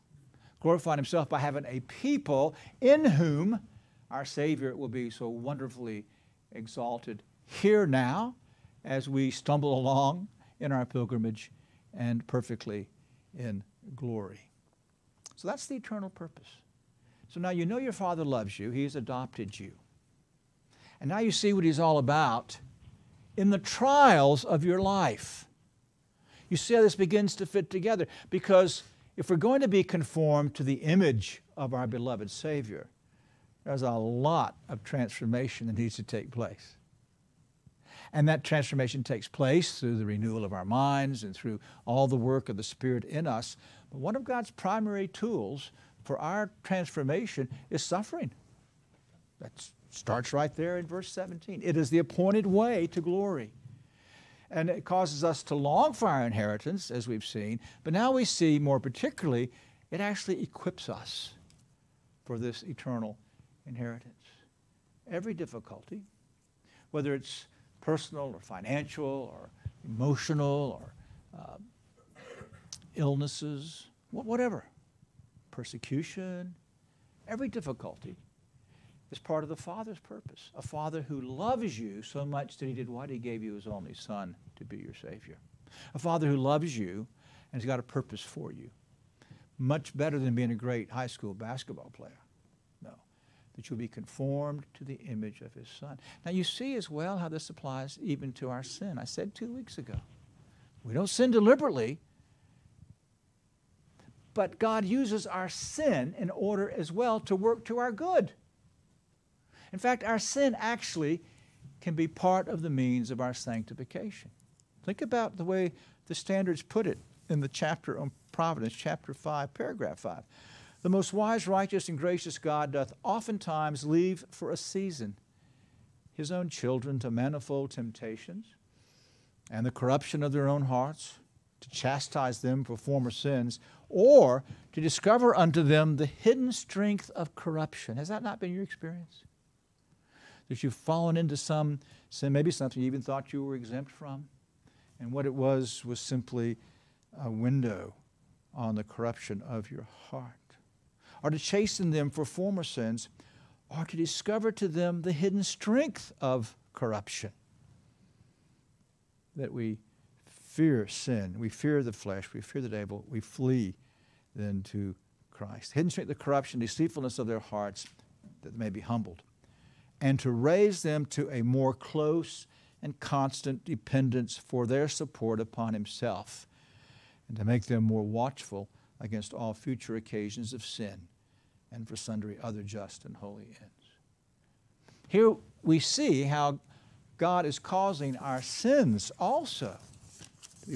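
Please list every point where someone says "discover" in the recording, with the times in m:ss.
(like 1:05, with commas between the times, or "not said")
2:14, 2:33.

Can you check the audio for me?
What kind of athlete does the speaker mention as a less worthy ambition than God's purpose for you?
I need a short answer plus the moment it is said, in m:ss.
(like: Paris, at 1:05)
High school basketball player, at 1:30.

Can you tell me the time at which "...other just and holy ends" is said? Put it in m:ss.
3:02.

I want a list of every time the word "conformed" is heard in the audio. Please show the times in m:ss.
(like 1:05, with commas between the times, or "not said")
0:29, 1:33.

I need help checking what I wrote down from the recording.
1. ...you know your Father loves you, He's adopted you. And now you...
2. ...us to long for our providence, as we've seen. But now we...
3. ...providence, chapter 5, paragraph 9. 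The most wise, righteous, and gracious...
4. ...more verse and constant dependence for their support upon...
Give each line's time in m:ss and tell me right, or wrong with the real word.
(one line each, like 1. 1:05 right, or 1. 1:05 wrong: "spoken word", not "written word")
1. 0:17 right
2. 0:55 wrong: "inheritance", not "providence"
3. 1:58 wrong: "5", not "9"
4. 2:51 wrong: "close", not "verse".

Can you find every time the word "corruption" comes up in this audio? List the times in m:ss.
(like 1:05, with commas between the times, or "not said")
2:09, 2:17, 2:28, 2:36, 2:46.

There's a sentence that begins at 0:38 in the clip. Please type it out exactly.
And that transformation takes place through the renewal of our minds and through all the work of the Spirit in us.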